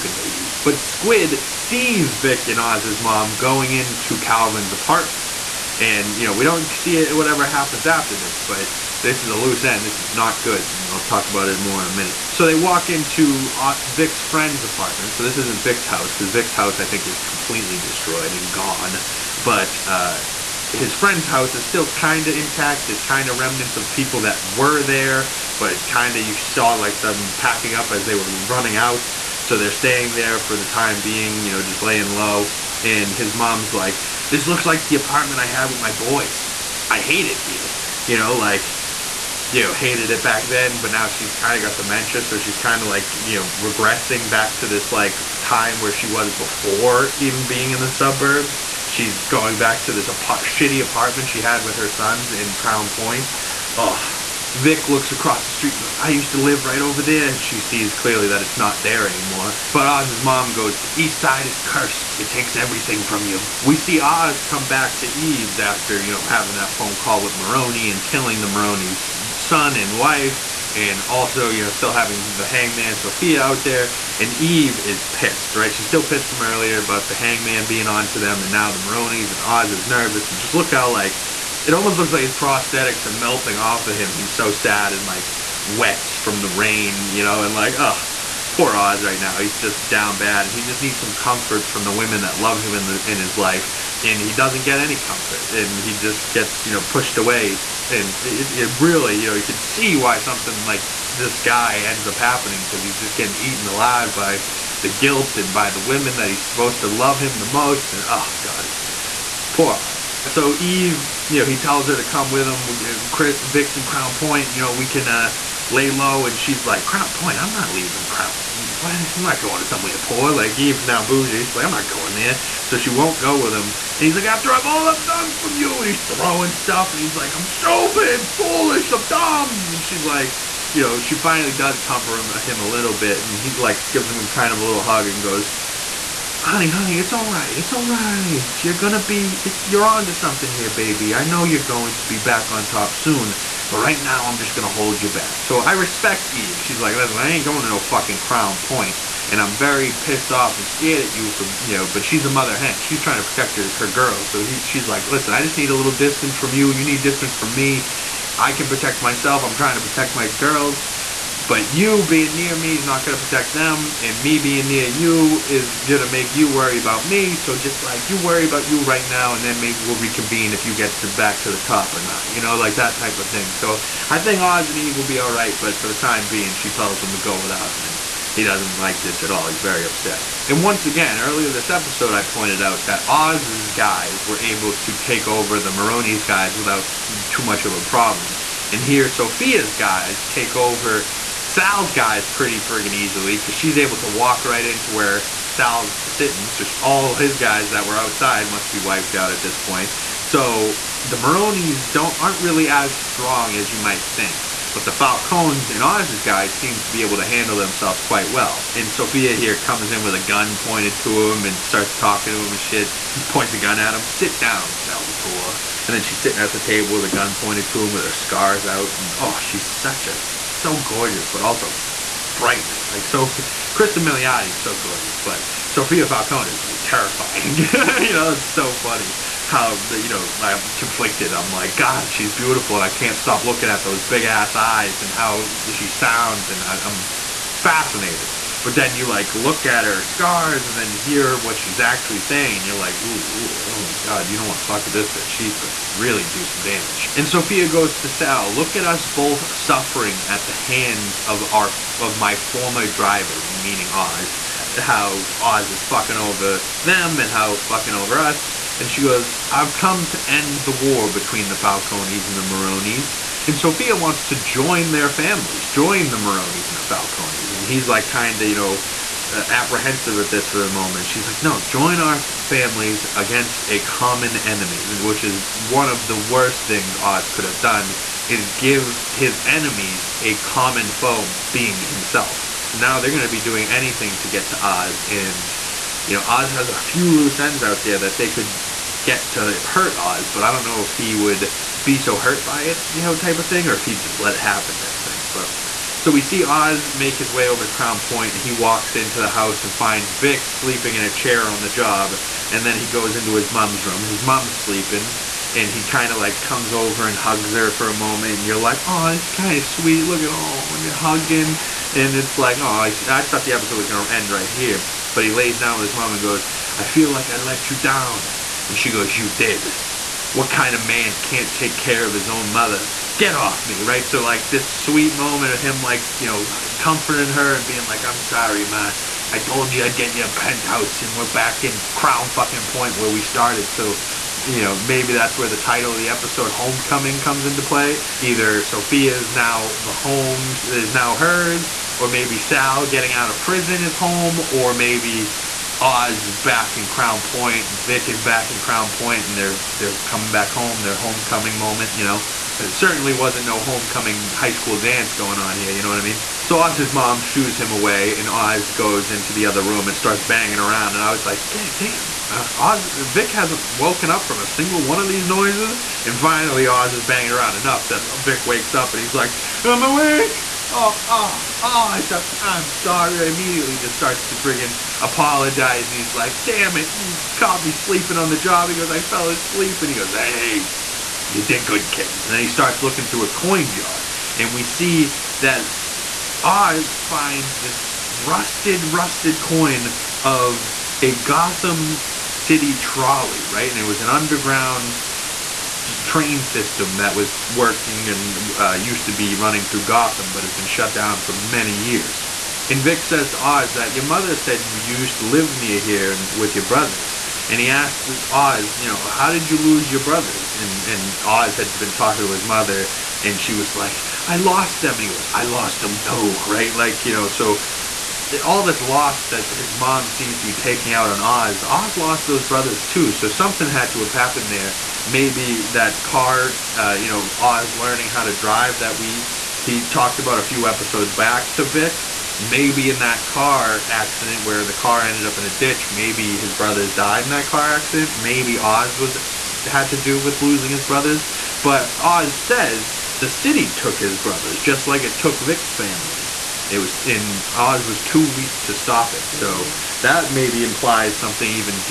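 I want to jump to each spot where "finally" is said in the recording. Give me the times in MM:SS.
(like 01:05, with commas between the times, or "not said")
02:11, 06:06.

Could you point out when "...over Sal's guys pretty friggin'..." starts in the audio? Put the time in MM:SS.
03:10.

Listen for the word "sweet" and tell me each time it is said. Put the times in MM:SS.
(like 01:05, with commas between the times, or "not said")
05:09, 05:24.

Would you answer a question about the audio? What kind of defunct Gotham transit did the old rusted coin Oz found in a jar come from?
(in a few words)
Trolley.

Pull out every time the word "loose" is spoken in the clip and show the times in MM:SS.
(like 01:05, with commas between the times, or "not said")
00:09, 04:47.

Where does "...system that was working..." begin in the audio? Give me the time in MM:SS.
06:36.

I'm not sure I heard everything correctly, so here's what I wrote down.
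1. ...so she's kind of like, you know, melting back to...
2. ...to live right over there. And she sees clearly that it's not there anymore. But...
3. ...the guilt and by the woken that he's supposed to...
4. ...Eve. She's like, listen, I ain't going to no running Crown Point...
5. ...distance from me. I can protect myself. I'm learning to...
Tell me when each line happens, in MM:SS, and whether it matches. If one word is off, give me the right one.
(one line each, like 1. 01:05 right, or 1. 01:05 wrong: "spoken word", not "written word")
1. 00:42 wrong: "regressing", not "melting"
2. 00:56 right
3. 01:44 wrong: "women", not "woken"
4. 02:26 wrong: "fucking", not "running"
5. 02:37 wrong: "trying", not "learning".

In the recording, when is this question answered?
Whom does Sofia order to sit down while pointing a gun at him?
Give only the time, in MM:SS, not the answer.
03:34.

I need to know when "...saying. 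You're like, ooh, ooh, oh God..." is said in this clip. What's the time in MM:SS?
04:02.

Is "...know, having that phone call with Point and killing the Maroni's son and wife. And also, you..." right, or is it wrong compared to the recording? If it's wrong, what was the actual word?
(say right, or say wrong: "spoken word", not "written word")
wrong: "Maroni", not "Point".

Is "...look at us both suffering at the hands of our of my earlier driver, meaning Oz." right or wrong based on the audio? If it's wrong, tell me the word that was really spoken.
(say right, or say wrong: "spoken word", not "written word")
wrong: "former", not "earlier".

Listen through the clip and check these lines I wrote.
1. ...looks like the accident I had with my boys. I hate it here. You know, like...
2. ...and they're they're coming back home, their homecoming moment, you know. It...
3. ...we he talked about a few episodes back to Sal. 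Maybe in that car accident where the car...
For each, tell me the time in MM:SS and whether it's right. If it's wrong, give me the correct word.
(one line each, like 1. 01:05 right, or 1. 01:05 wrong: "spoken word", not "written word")
1. 00:34 wrong: "apartment", not "accident"
2. 05:49 right
3. 07:08 wrong: "Vic", not "Sal".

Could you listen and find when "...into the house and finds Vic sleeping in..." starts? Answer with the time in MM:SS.
04:58.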